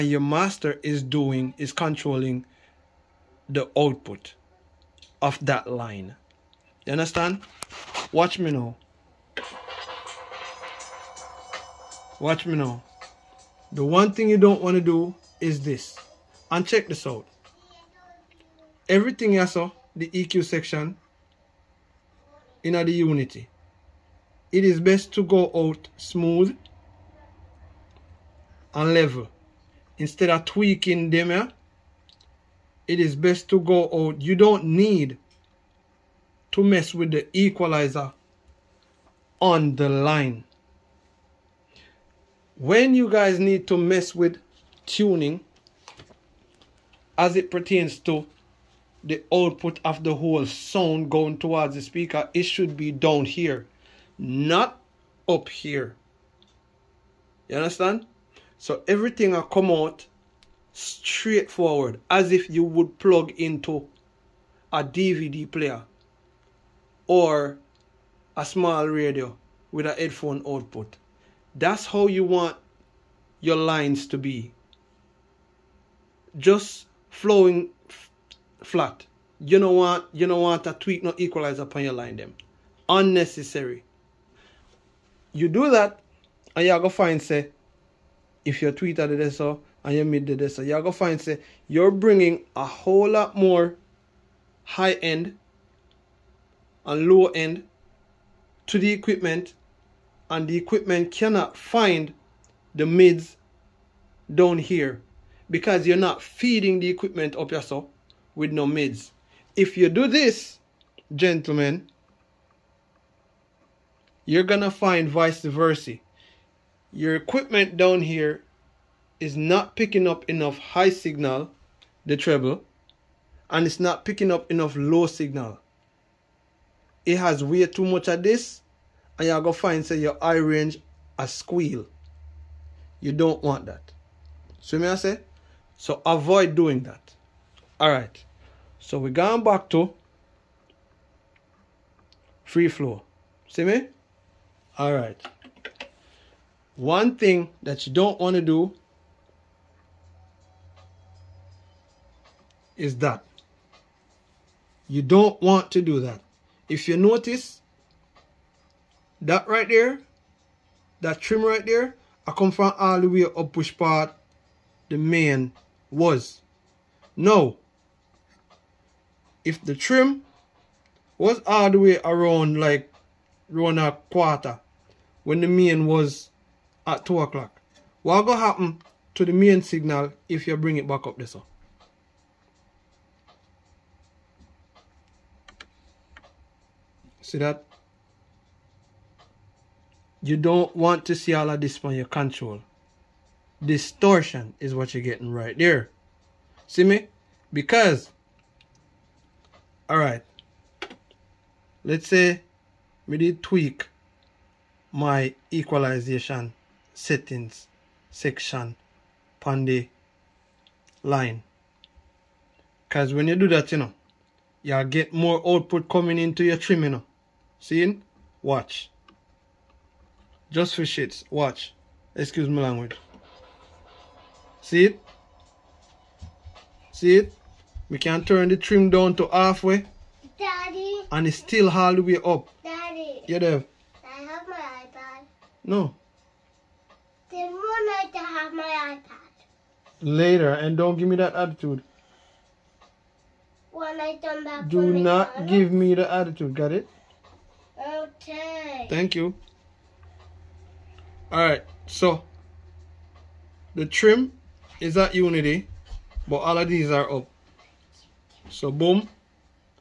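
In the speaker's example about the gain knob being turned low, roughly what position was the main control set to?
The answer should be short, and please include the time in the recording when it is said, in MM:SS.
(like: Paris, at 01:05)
2 o'clock, at 02:57.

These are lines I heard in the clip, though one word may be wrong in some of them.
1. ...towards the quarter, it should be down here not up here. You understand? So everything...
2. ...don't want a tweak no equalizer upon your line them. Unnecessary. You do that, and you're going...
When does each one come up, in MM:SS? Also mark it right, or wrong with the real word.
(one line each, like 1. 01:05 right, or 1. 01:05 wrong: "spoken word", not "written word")
1. 00:51 wrong: "speaker", not "quarter"
2. 01:20 right.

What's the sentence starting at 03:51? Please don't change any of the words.
and it's still all the way up Daddy.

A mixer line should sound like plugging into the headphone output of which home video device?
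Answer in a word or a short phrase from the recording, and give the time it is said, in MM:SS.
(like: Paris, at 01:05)
DVD player, at 01:04.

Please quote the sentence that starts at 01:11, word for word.
That's how you want your lines to be.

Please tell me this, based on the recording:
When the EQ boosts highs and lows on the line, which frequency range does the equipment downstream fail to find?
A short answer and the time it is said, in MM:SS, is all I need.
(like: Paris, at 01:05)
the mids, at 01:42.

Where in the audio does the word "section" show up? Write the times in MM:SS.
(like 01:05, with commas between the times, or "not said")
00:20, 03:28.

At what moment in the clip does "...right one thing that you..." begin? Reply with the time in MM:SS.
02:24.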